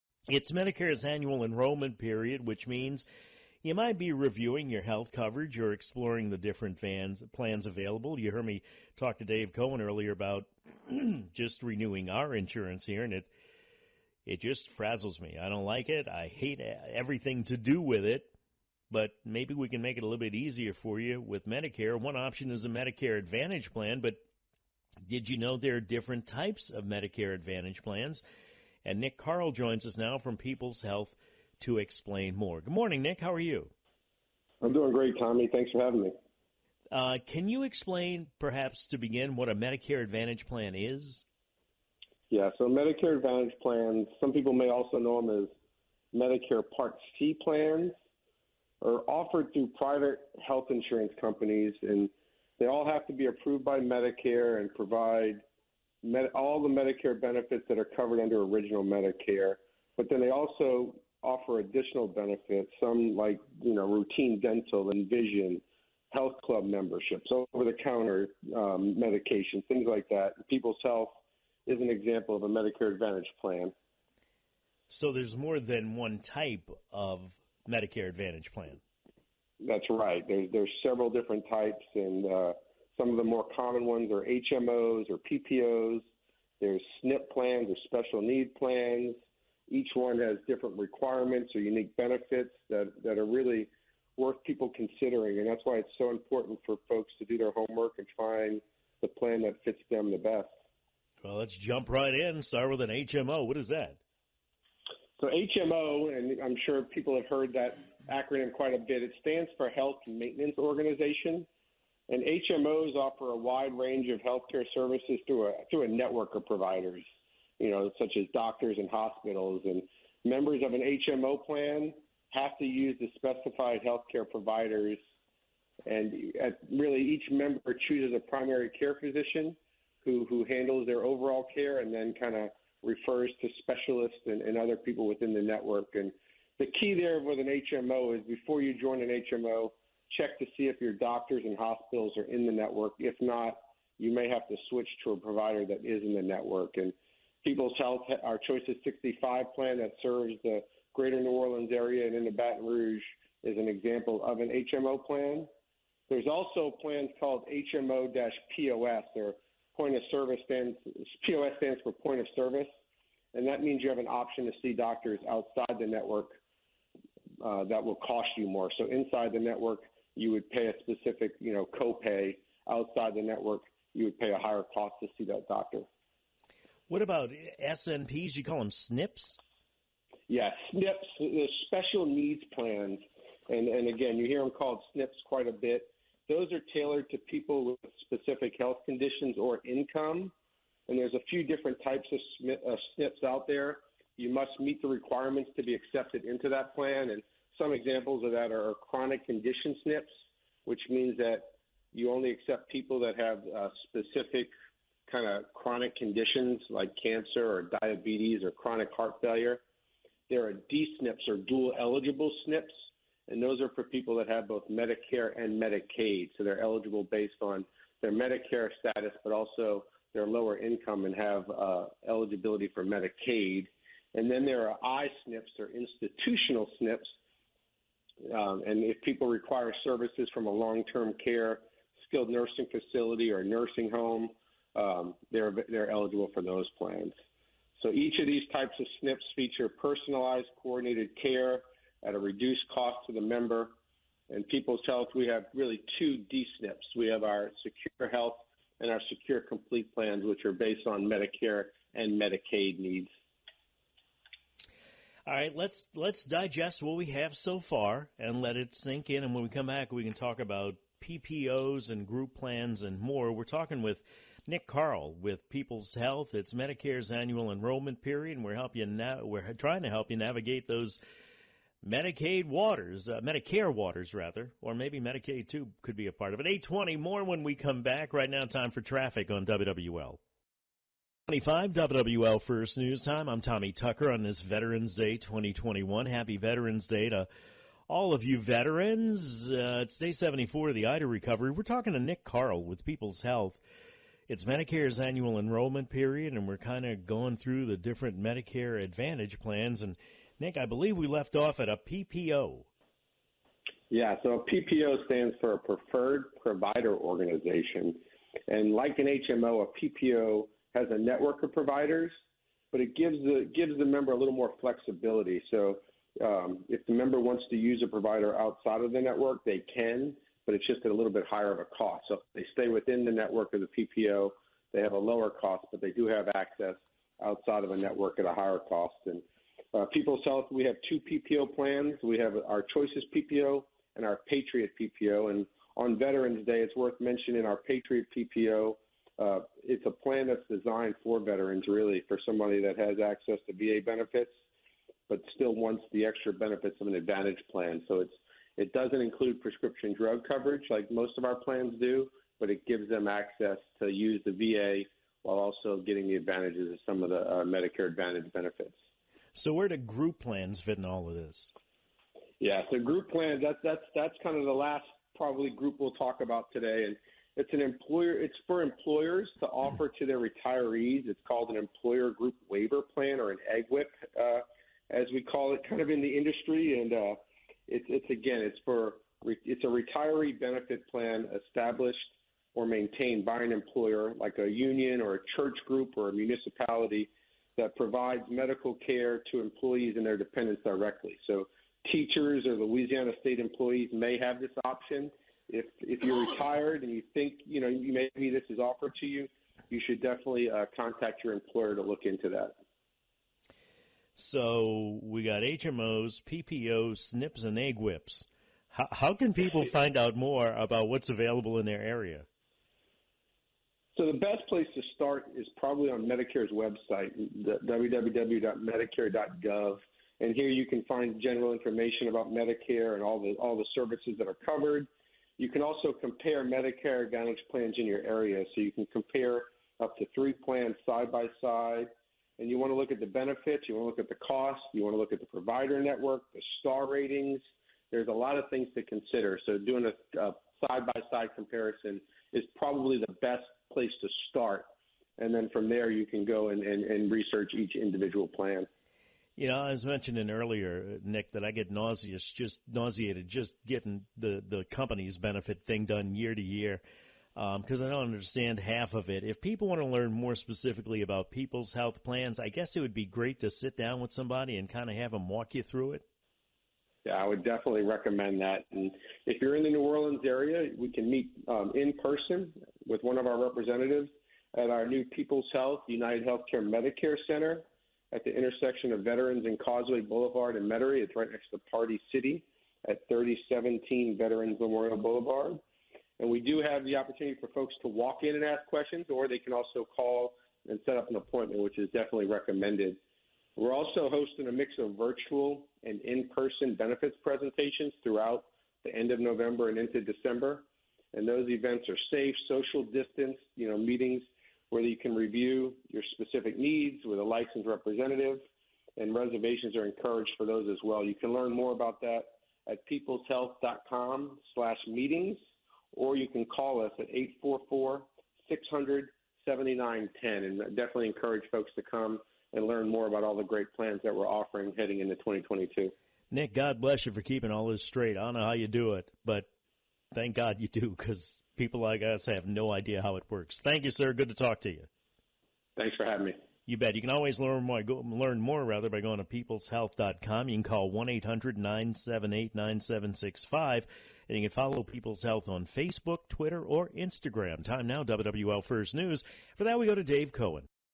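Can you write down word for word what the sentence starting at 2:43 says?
And that means you have an option to see doctors outside the network uh, that will cost you more.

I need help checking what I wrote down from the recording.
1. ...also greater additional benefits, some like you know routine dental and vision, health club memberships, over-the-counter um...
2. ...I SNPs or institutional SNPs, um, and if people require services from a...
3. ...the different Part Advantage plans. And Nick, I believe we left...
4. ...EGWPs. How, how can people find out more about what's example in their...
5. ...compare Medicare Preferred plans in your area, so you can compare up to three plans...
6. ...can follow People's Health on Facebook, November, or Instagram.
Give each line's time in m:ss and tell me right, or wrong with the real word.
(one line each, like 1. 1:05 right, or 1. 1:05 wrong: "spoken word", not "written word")
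1. 1:00 wrong: "offer", not "greater"
2. 3:44 right
3. 4:57 wrong: "Medicare", not "Part"
4. 6:47 wrong: "available", not "example"
5. 7:05 wrong: "Advantage", not "Preferred"
6. 9:04 wrong: "Twitter", not "November".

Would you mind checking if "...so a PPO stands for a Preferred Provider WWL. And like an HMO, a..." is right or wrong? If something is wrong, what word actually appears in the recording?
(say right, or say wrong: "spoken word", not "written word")
wrong: "Organization", not "WWL".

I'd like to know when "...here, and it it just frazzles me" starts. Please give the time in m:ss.
0:12.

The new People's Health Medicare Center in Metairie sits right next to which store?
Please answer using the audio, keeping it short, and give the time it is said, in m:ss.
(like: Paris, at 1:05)
Party City, at 8:01.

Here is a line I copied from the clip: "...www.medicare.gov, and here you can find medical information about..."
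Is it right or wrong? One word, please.
wrong.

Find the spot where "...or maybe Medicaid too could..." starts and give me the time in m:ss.
4:34.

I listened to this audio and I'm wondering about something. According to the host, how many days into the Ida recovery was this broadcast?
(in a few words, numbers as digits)
74.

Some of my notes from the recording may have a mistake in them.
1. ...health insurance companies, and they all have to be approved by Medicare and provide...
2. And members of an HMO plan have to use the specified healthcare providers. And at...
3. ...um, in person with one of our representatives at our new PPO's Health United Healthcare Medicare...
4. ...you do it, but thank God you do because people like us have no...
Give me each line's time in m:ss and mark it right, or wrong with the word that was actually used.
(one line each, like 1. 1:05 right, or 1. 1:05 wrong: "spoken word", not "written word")
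1. 0:50 right
2. 1:59 right
3. 7:51 wrong: "People", not "PPO"
4. 8:48 right.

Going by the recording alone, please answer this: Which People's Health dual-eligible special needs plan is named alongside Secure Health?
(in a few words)
Secure Complete.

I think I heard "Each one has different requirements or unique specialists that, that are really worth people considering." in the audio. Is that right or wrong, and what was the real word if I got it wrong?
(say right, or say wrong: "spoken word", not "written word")
wrong: "benefits", not "specialists".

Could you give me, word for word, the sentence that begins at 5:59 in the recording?
So where do group plans fit in all of this?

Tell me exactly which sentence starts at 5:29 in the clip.
And uh, People's Health, we have two PPO plans.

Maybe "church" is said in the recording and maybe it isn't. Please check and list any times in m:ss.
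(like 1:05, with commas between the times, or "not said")
6:25.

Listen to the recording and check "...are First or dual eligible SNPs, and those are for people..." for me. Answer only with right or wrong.
wrong.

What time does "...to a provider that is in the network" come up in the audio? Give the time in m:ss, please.
2:25.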